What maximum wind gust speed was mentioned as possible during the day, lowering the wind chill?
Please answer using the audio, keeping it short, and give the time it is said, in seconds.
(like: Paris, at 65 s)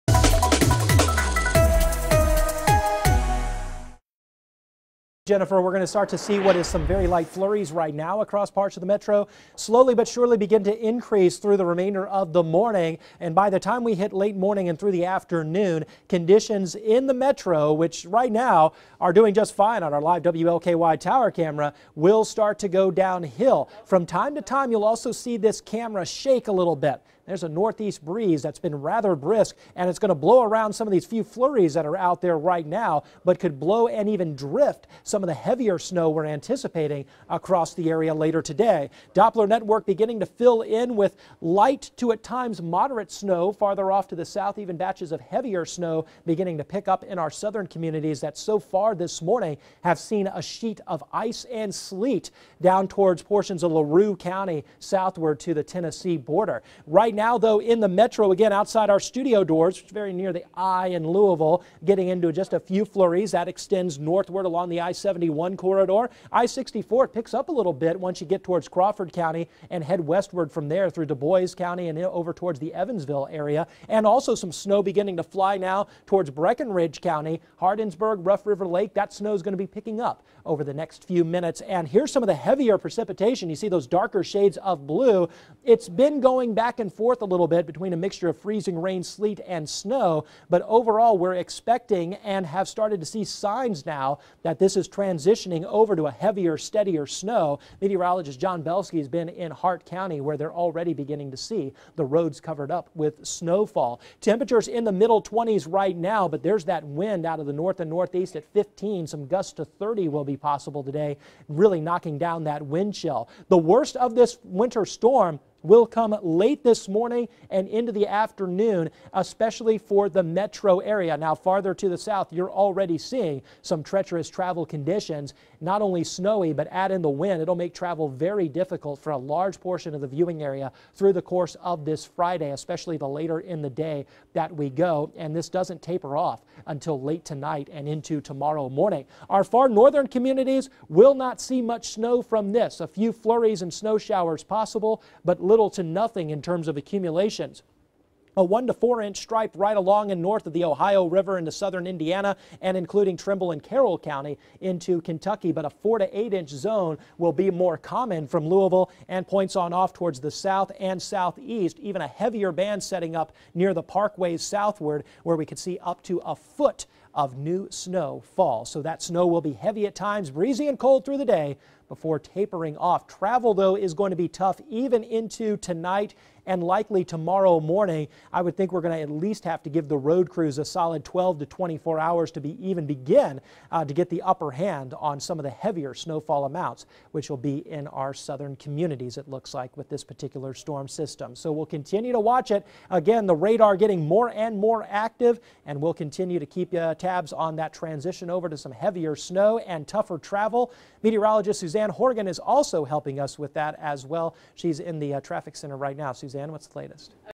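30, at 109 s.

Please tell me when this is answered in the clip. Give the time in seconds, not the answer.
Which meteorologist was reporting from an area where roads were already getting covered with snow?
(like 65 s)
98 s.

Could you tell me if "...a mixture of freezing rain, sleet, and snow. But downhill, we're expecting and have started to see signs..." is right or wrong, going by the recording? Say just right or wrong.
wrong.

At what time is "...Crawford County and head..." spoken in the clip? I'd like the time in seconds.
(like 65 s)
68 s.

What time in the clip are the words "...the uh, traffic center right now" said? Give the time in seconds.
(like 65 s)
204 s.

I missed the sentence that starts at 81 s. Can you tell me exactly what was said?
And here's some of the heavier precipitation.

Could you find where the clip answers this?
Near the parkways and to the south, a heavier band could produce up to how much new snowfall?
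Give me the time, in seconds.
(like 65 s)
166 s.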